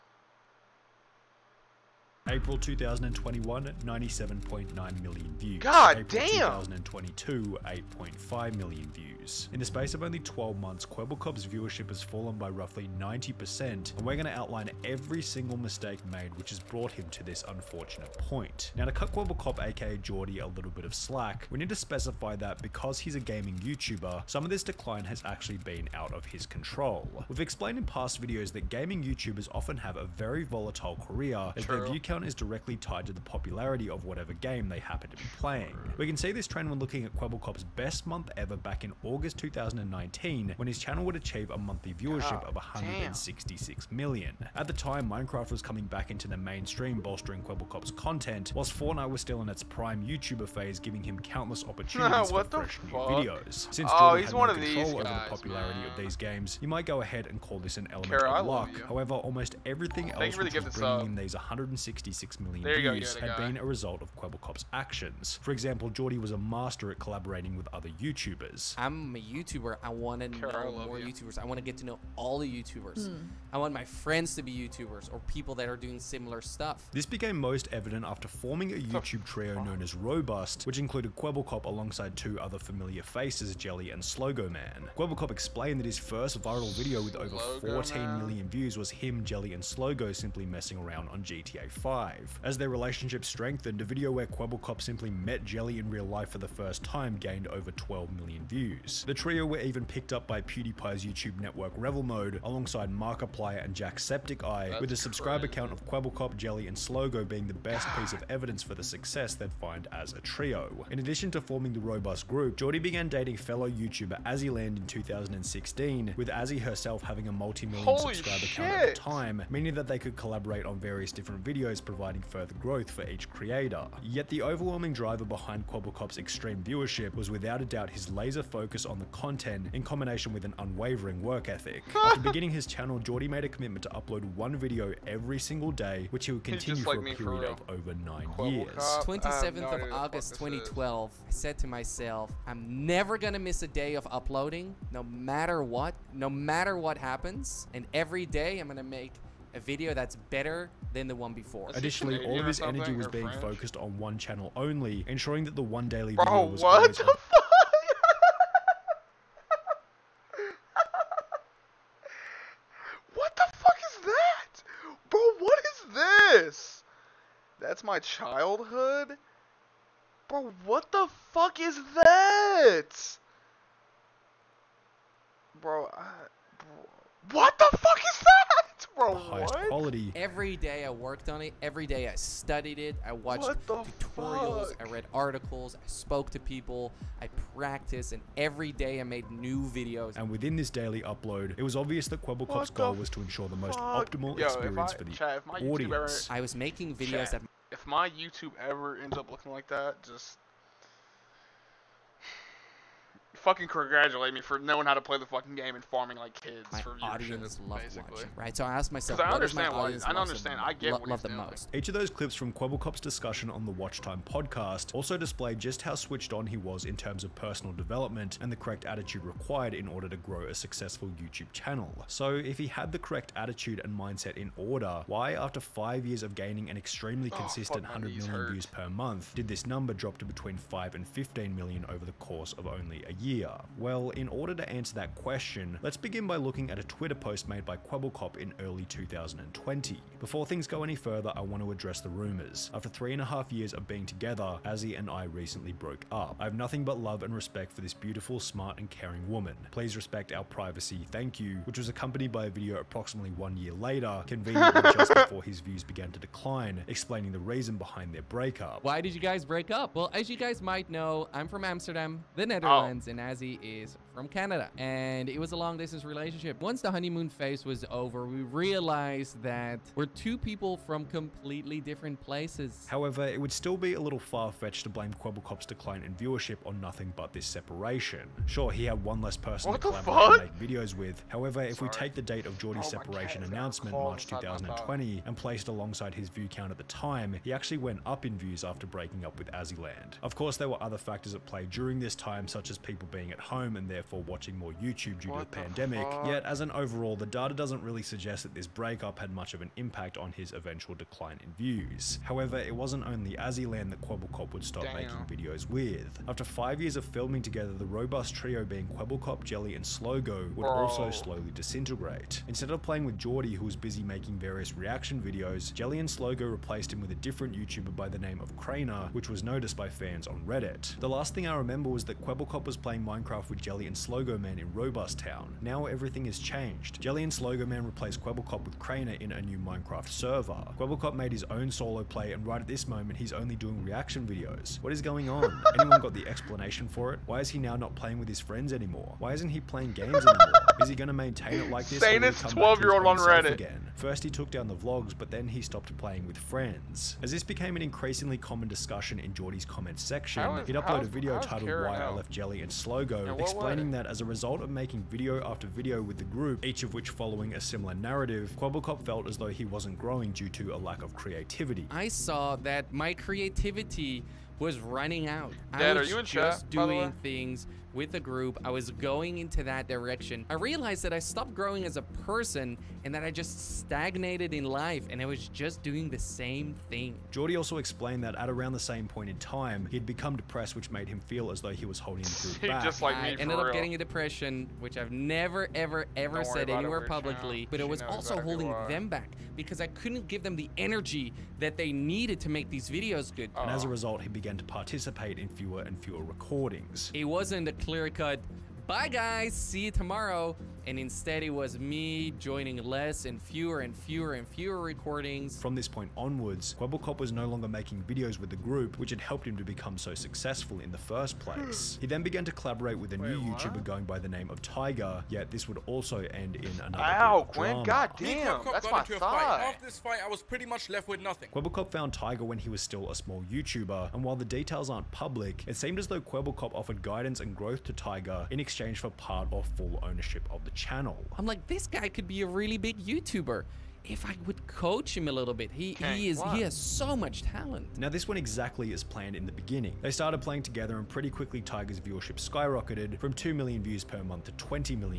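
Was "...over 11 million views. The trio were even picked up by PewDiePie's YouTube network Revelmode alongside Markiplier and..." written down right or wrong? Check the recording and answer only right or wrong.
wrong.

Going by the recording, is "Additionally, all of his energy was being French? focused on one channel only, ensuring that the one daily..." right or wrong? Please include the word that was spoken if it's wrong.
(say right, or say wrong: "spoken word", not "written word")
right.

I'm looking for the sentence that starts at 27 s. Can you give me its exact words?
We've explained in past videos that gaming YouTubers often have a very volatile career, as True.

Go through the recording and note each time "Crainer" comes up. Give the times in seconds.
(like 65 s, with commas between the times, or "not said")
318 s, 328 s.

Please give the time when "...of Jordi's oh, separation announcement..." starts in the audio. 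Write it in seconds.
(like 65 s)
282 s.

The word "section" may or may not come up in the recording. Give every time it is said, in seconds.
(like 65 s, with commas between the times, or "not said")
350 s.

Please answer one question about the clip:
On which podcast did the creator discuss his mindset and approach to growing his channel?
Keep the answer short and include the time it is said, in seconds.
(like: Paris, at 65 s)
Watch Time, at 213 s.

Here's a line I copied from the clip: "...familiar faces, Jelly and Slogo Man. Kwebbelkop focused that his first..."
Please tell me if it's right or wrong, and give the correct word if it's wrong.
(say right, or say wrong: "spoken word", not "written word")
wrong: "explained", not "focused".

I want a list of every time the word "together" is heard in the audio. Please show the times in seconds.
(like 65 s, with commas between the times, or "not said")
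244 s, 307 s, 440 s.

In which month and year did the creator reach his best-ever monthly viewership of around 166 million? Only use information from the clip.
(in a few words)
August 2019.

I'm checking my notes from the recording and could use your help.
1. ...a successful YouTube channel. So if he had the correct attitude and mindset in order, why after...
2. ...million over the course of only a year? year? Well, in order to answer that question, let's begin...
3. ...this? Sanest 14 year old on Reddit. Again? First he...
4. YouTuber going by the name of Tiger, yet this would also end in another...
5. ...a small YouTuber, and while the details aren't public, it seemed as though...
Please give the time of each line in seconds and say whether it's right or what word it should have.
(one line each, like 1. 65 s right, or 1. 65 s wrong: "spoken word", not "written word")
1. 220 s right
2. 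231 s right
3. 341 s wrong: "12", not "14"
4. 413 s right
5. 423 s right.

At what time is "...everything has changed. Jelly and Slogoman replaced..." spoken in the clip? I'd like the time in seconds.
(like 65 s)
325 s.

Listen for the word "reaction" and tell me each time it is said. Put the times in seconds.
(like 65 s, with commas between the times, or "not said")
314 s, 333 s.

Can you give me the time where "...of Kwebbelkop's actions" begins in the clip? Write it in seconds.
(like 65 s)
64 s.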